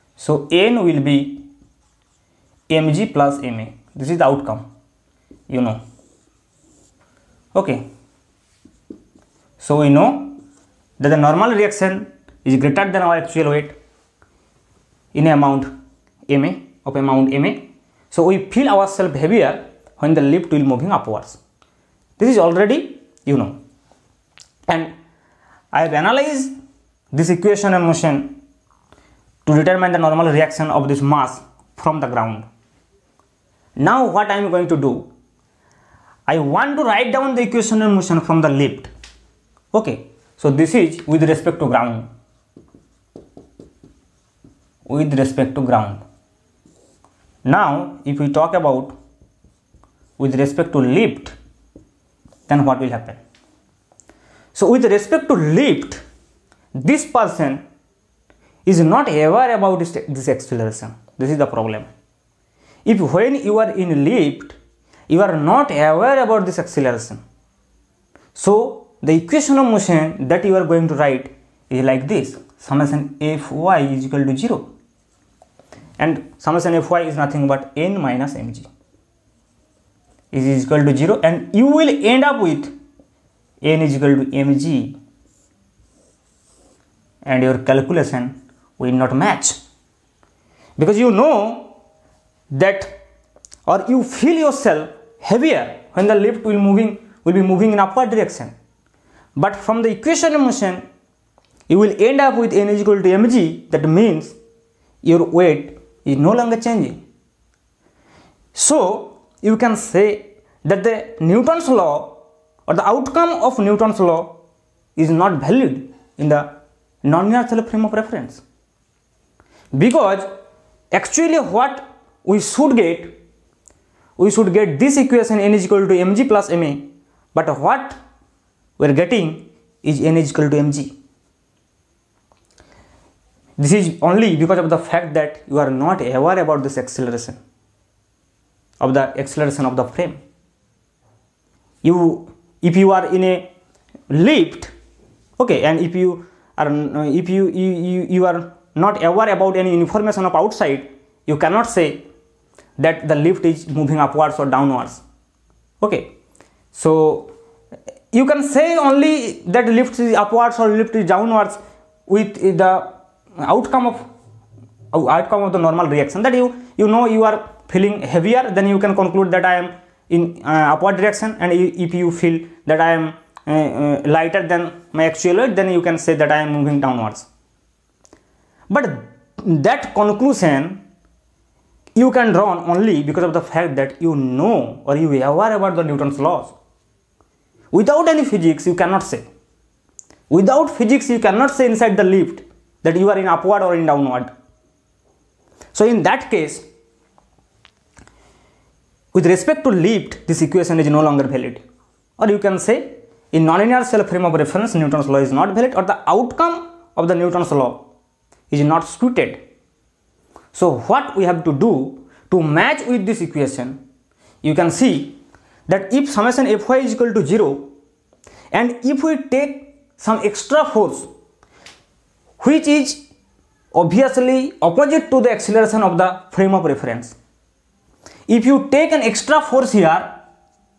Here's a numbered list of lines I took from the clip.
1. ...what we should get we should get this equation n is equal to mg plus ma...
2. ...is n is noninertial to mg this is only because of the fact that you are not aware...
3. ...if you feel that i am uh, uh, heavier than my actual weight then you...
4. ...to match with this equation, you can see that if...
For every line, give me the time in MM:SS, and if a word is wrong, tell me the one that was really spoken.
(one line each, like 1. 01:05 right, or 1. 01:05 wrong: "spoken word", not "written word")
1. 02:01 right
2. 02:09 wrong: "equal", not "noninertial"
3. 02:51 wrong: "lighter", not "heavier"
4. 03:32 right.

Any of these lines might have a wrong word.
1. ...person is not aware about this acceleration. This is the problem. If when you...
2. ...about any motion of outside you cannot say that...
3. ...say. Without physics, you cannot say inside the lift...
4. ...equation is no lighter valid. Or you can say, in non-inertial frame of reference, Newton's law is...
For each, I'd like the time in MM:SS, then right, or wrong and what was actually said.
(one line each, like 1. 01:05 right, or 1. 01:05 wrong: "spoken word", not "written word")
1. 00:57 right
2. 02:29 wrong: "information", not "motion"
3. 03:09 right
4. 03:20 wrong: "longer", not "lighter".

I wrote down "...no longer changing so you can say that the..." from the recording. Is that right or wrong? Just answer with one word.
right.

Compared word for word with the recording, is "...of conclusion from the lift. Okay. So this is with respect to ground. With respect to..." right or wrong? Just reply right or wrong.
wrong.